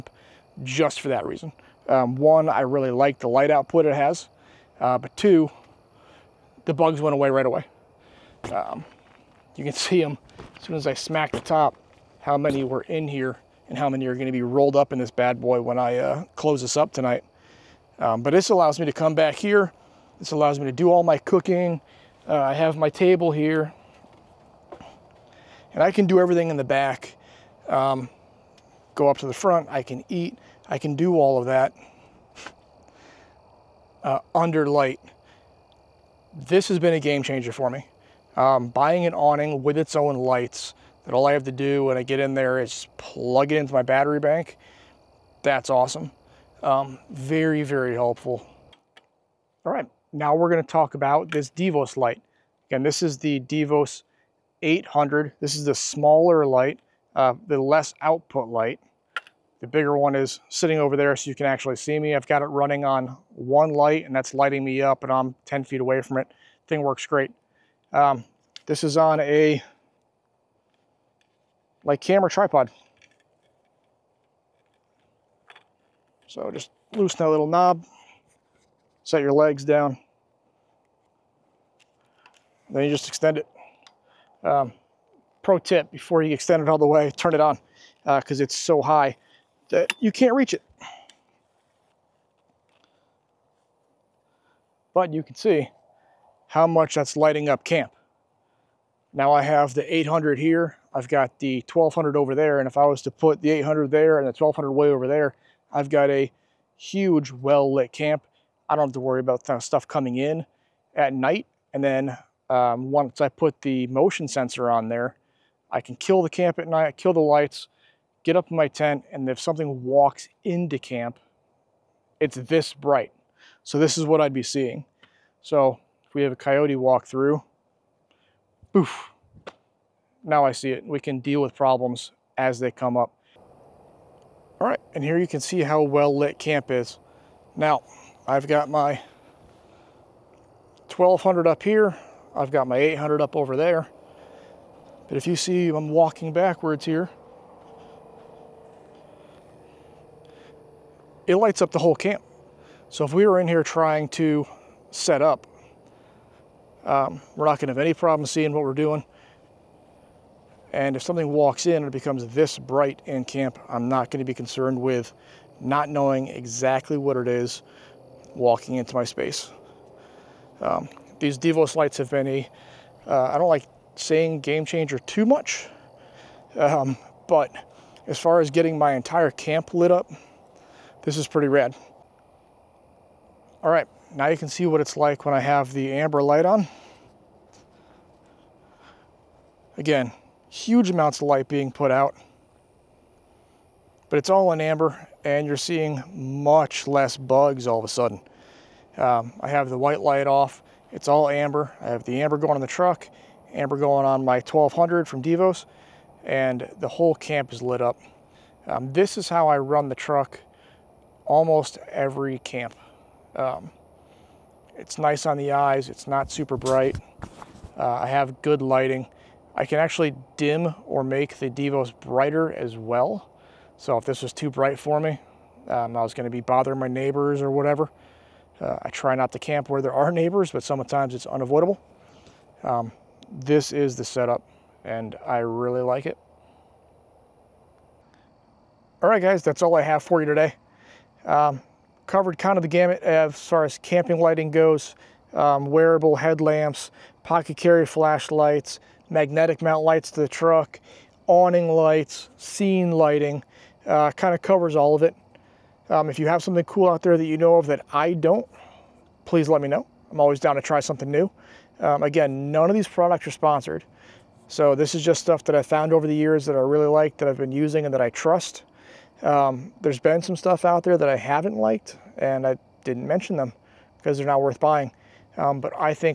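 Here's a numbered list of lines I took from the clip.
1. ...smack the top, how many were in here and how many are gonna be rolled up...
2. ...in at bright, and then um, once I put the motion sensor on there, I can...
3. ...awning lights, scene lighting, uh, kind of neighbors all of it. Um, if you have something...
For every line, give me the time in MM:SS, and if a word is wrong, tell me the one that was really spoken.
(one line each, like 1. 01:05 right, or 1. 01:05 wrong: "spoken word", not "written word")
1. 00:10 right
2. 01:50 wrong: "night", not "bright"
3. 04:11 wrong: "covers", not "neighbors".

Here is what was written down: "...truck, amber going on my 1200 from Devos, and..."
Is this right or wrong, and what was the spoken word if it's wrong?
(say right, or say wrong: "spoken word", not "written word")
right.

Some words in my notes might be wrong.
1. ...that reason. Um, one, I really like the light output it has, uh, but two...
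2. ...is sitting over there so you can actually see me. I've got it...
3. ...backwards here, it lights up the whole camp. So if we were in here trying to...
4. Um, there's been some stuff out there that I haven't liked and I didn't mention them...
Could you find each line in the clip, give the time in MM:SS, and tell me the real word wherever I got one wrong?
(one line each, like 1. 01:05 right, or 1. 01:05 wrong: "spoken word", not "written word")
1. 00:01 right
2. 01:00 right
3. 02:26 right
4. 04:29 right.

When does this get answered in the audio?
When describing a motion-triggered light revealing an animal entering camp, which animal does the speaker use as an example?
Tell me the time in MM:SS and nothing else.
02:06.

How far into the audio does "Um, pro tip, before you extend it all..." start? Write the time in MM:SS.
01:24.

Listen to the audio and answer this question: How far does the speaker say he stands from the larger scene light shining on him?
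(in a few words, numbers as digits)
10 feet.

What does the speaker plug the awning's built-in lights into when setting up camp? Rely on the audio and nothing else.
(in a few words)
battery bank.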